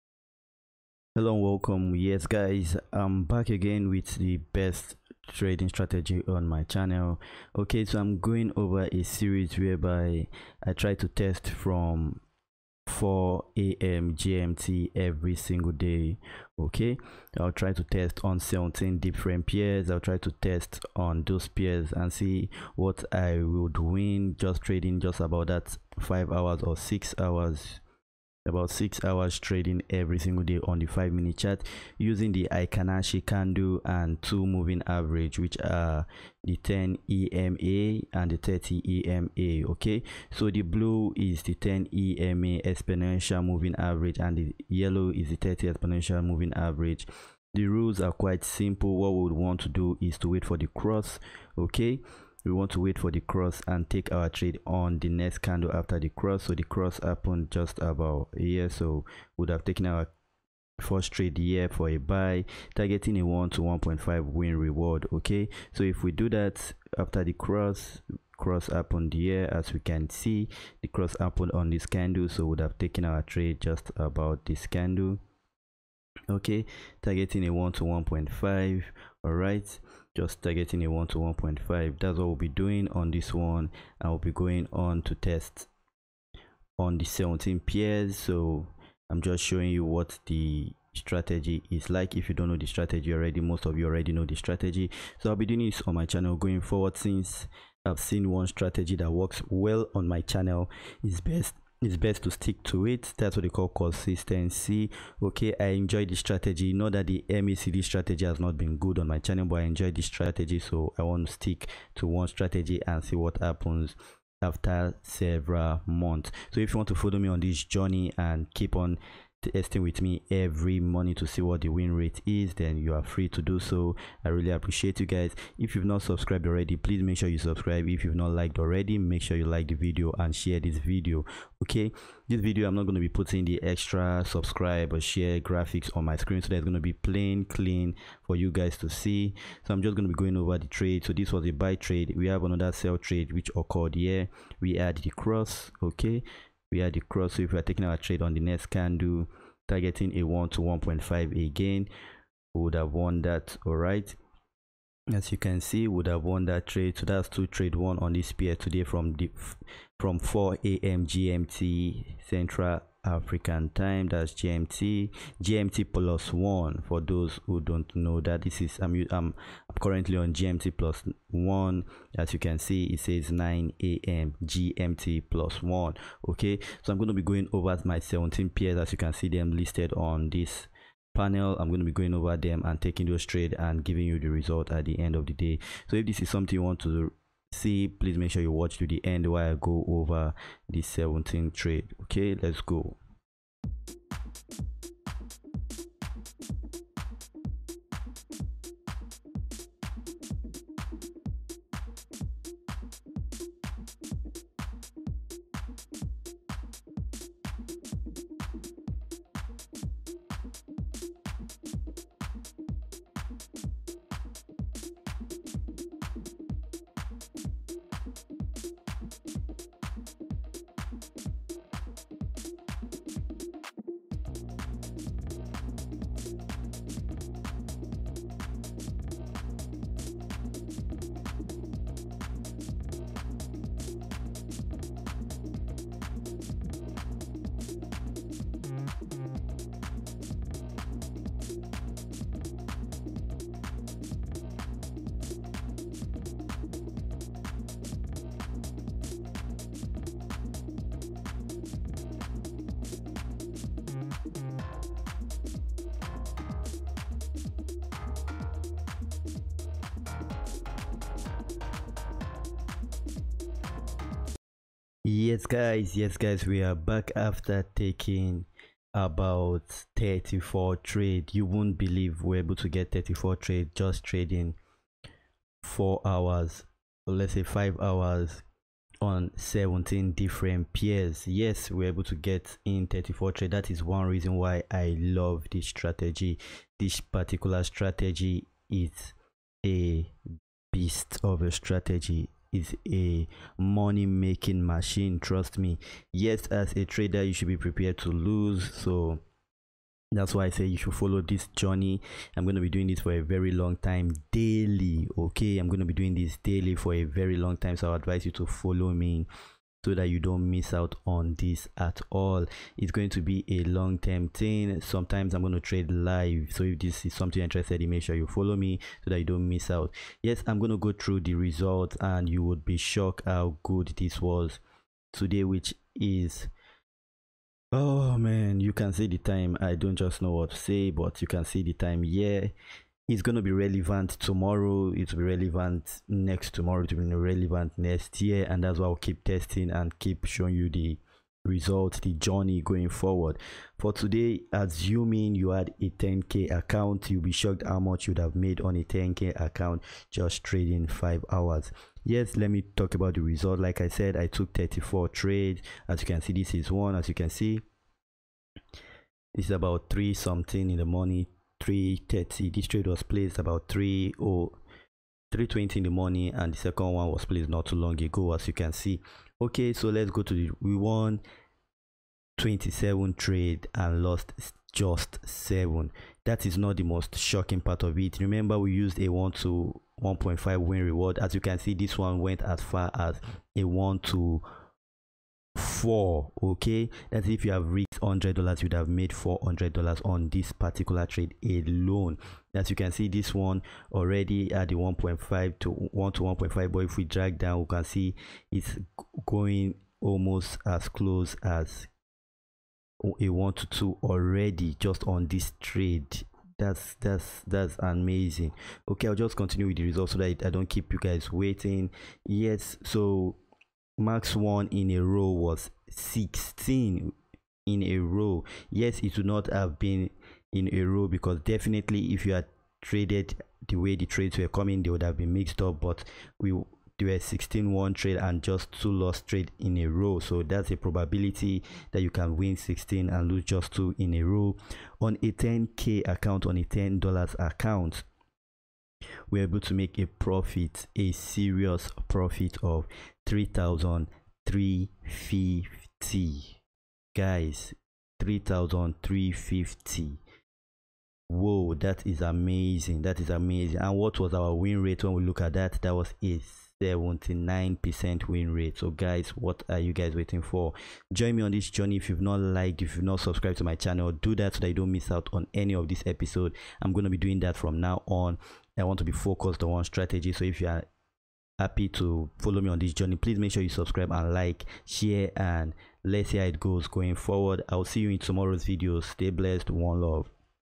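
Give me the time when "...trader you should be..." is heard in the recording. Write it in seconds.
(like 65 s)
296 s.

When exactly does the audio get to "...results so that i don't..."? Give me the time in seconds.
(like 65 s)
409 s.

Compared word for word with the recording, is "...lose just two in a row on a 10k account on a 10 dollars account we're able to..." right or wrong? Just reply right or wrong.
right.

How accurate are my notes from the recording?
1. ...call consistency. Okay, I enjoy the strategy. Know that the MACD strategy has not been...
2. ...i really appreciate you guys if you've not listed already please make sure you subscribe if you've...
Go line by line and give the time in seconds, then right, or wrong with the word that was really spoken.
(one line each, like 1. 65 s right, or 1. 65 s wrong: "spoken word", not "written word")
1. 103 s right
2. 124 s wrong: "subscribed", not "listed".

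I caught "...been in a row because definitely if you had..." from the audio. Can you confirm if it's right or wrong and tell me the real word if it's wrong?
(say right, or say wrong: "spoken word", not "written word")
right.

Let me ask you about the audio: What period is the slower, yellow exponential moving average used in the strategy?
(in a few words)
30.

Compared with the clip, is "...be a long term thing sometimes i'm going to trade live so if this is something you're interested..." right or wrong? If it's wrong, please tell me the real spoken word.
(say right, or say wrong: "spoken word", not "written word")
right.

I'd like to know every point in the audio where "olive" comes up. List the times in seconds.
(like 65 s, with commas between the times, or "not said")
not said.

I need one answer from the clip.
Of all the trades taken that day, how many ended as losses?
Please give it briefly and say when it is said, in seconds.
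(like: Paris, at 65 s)
7, at 374 s.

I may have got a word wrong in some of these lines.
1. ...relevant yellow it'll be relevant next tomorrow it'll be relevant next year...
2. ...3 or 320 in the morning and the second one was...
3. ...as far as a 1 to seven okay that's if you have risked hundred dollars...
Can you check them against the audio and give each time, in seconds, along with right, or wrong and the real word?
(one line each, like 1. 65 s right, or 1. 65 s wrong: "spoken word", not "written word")
1. 333 s wrong: "tomorrow", not "yellow"
2. 363 s right
3. 382 s wrong: "four", not "seven".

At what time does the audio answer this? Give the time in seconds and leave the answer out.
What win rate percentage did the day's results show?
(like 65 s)
456 s.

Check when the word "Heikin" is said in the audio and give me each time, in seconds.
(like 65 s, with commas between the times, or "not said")
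32 s.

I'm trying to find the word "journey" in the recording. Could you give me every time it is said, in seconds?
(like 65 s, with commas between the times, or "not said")
117 s, 301 s, 342 s, 461 s, 472 s.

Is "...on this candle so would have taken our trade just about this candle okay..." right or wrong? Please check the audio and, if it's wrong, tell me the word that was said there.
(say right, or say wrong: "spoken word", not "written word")
right.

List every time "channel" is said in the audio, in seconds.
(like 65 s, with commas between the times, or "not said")
6 s, 96 s, 100 s, 109 s, 463 s.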